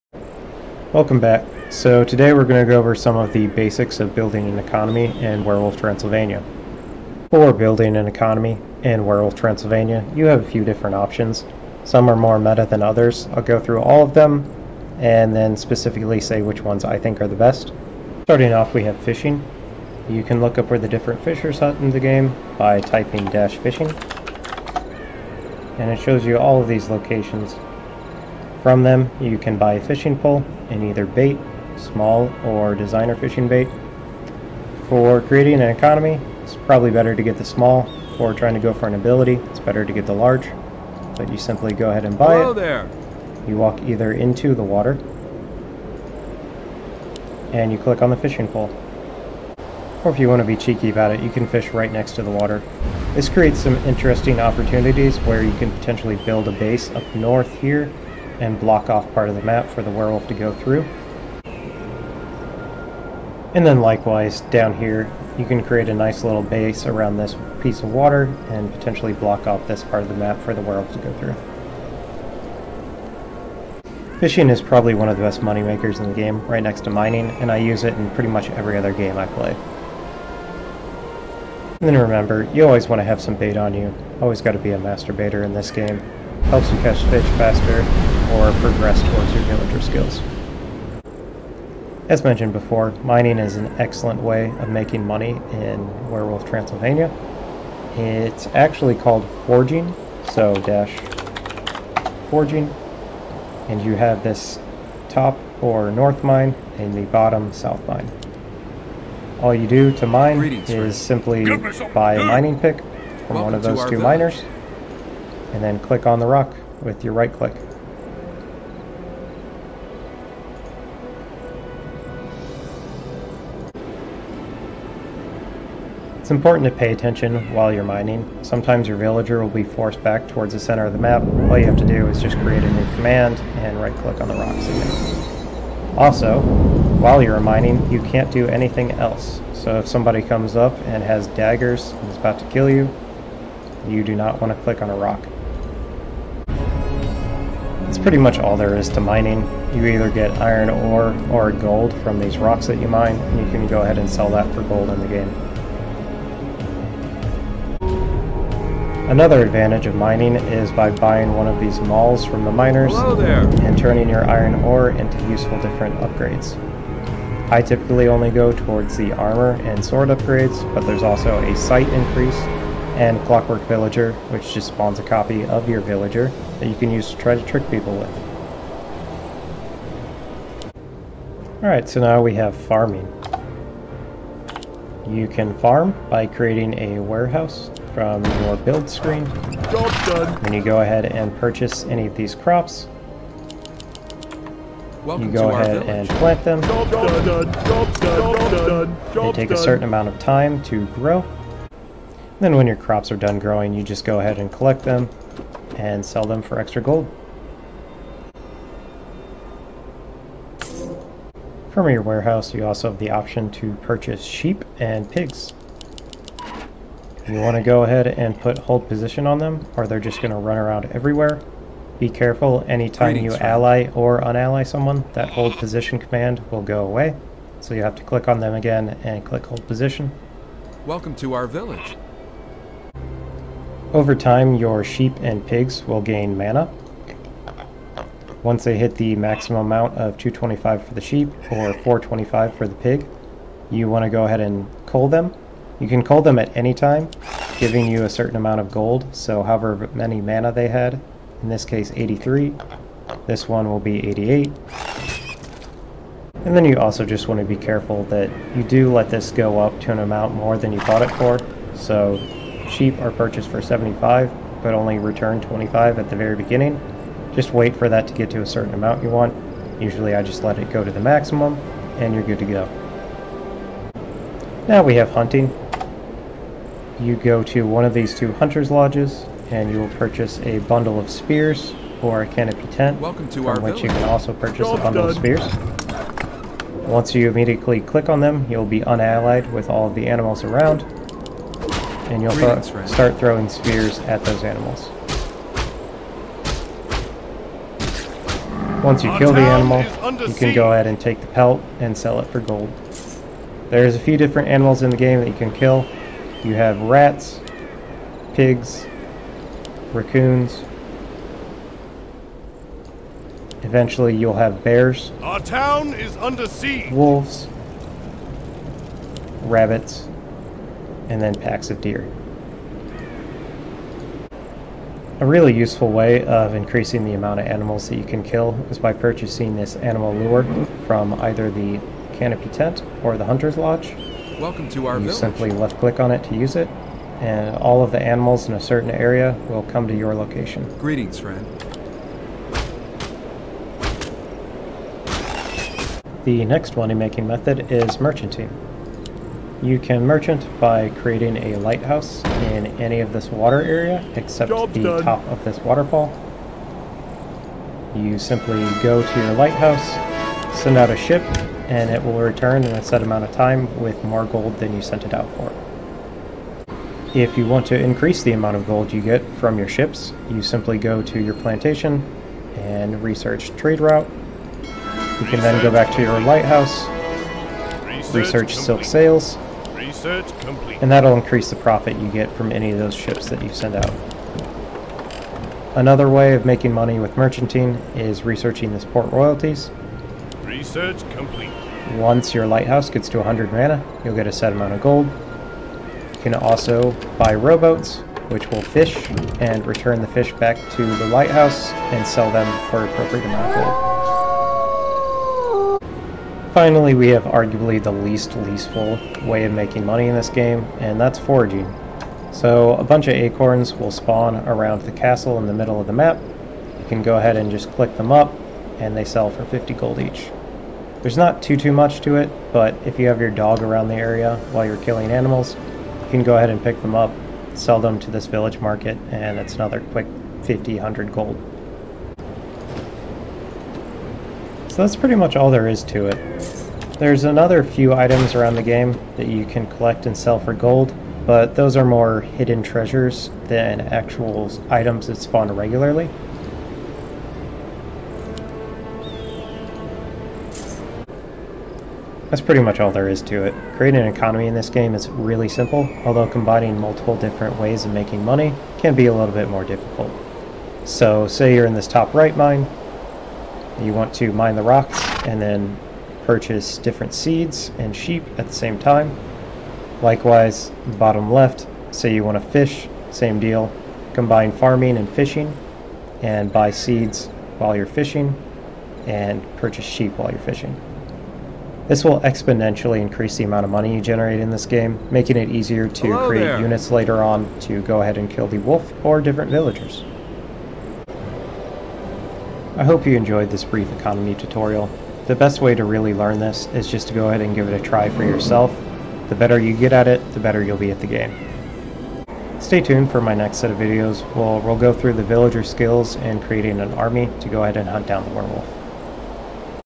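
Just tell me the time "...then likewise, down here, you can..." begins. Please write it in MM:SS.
01:03.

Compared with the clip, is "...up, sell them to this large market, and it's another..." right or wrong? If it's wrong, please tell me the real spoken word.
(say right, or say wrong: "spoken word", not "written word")
wrong: "village", not "large".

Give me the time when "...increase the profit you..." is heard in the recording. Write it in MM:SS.
06:21.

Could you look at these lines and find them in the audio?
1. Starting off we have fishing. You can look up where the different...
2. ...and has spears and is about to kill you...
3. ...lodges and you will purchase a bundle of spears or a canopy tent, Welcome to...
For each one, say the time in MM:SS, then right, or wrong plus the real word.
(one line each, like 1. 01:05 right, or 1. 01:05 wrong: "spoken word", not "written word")
1. 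00:18 right
2. 02:20 wrong: "daggers", not "spears"
3. 04:38 right.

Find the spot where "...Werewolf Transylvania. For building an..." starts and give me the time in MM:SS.
00:05.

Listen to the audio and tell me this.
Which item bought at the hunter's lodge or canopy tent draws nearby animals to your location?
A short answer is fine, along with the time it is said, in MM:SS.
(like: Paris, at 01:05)
Animal lure, at 05:29.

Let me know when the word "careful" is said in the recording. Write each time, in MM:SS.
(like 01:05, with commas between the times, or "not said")
03:42, 04:17.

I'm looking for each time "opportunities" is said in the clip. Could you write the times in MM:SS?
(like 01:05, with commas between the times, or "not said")
00:54.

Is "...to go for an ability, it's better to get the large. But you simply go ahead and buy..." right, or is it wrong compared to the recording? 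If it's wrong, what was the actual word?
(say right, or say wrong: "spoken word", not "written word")
right.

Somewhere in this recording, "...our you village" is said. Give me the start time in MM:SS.
05:34.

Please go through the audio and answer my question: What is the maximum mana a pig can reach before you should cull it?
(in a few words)
425.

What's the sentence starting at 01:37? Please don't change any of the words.
It's actually called forging, so dash forging, and you have this top or north mine and the bottom south mine.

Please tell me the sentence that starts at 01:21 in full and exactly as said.
And then remember, you always want to have some bait on you.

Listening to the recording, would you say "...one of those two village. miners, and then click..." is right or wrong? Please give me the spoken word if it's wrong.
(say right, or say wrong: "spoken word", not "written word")
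right.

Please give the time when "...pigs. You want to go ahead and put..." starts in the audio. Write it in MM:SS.
03:35.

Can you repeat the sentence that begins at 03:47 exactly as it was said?
So you have to click on them again and click hold position.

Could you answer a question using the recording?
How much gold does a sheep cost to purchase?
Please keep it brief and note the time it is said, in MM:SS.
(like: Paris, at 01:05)
75, at 04:23.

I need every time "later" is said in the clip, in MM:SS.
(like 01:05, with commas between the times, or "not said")
08:06.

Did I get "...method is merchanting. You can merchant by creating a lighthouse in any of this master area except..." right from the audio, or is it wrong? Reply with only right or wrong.
wrong.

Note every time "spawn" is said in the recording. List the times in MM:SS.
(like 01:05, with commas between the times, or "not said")
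02:54, 06:53, 07:25.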